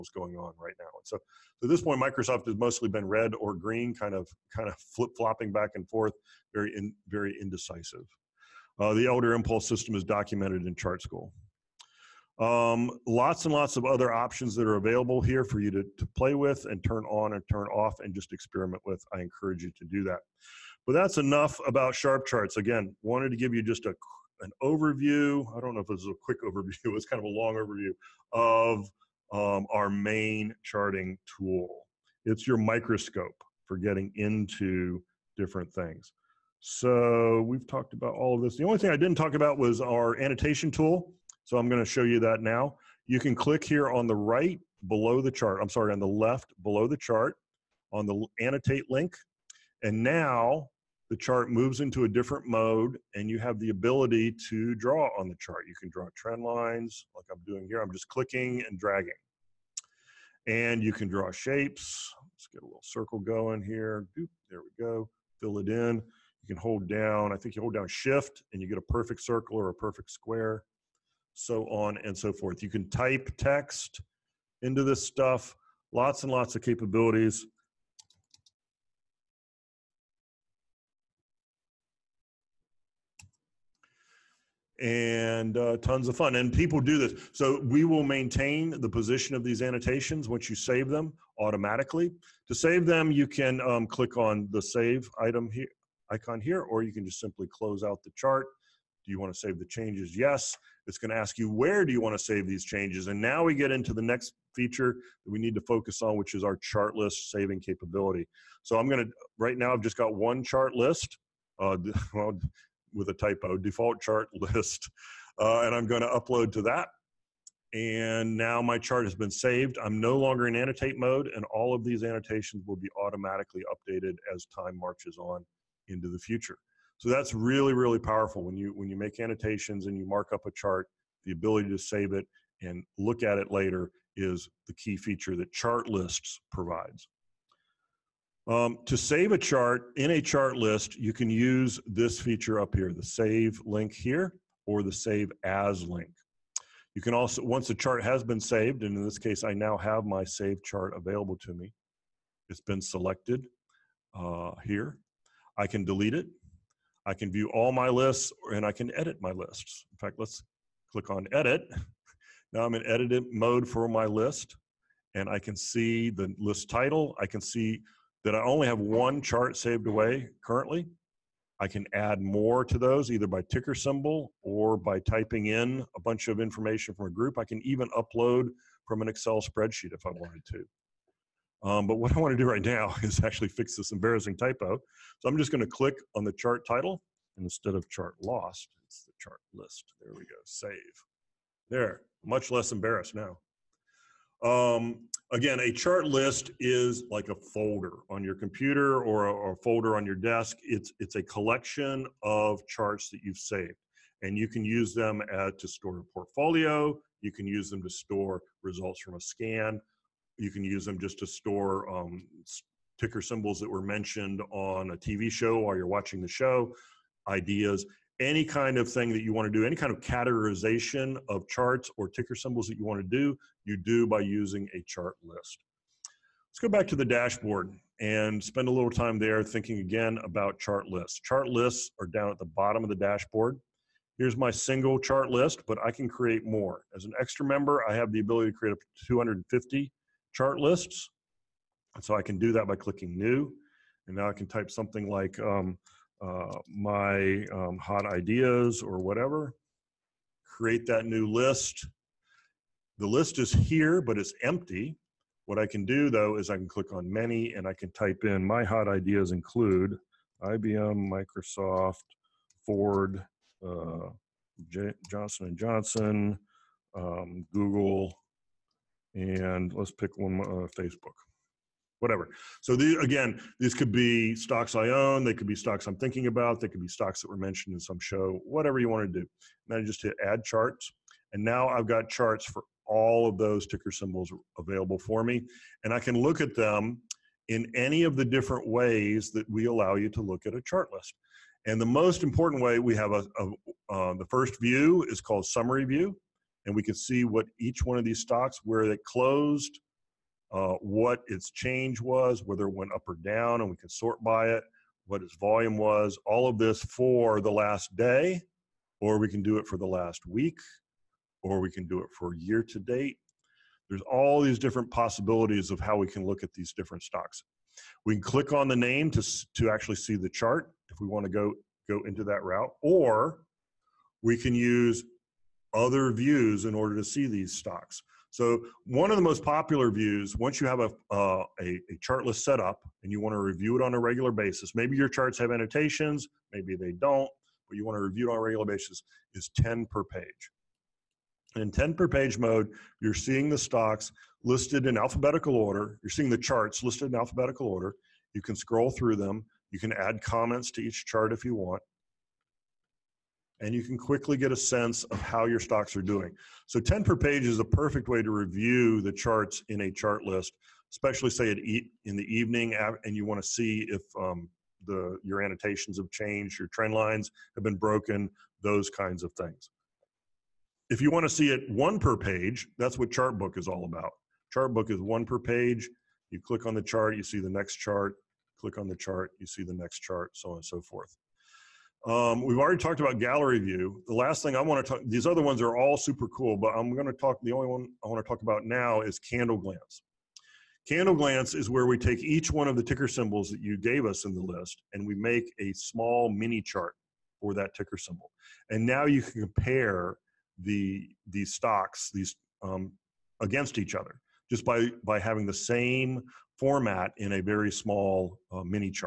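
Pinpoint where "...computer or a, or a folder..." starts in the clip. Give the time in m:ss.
3:18.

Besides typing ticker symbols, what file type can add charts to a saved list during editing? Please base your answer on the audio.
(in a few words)
Excel spreadsheet.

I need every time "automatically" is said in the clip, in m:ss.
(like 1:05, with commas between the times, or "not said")
1:31, 2:02.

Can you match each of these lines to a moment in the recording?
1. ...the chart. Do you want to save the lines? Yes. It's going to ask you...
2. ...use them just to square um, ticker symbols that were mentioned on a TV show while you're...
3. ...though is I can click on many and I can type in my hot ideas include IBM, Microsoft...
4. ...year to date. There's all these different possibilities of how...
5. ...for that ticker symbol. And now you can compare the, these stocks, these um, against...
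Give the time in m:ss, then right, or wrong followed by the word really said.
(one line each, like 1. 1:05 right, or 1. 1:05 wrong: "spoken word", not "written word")
1. 1:38 wrong: "changes", not "lines"
2. 3:30 wrong: "store", not "square"
3. 4:16 right
4. 5:12 right
5. 6:37 right.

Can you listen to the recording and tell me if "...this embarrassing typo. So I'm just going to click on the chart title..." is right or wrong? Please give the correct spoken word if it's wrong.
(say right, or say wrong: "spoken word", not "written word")
right.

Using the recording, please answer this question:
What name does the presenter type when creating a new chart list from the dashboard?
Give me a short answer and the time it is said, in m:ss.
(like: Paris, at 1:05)
my hot ideas, at 4:06.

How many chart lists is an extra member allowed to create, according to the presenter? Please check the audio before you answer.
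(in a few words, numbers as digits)
250.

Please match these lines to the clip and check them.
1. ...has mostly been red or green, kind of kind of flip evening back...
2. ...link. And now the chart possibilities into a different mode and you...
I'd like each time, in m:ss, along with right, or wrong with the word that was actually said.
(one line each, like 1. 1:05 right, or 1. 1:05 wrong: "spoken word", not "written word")
1. 0:02 wrong: "flopping", not "evening"
2. 0:48 wrong: "moves", not "possibilities".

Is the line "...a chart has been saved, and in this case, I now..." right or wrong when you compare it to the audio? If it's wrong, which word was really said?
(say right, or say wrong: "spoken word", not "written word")
right.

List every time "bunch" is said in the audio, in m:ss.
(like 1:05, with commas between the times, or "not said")
2:56.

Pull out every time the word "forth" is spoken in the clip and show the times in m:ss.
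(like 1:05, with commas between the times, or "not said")
0:05, 1:12, 6:20.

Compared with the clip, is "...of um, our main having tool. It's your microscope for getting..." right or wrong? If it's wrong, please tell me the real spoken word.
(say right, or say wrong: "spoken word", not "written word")
wrong: "charting", not "having".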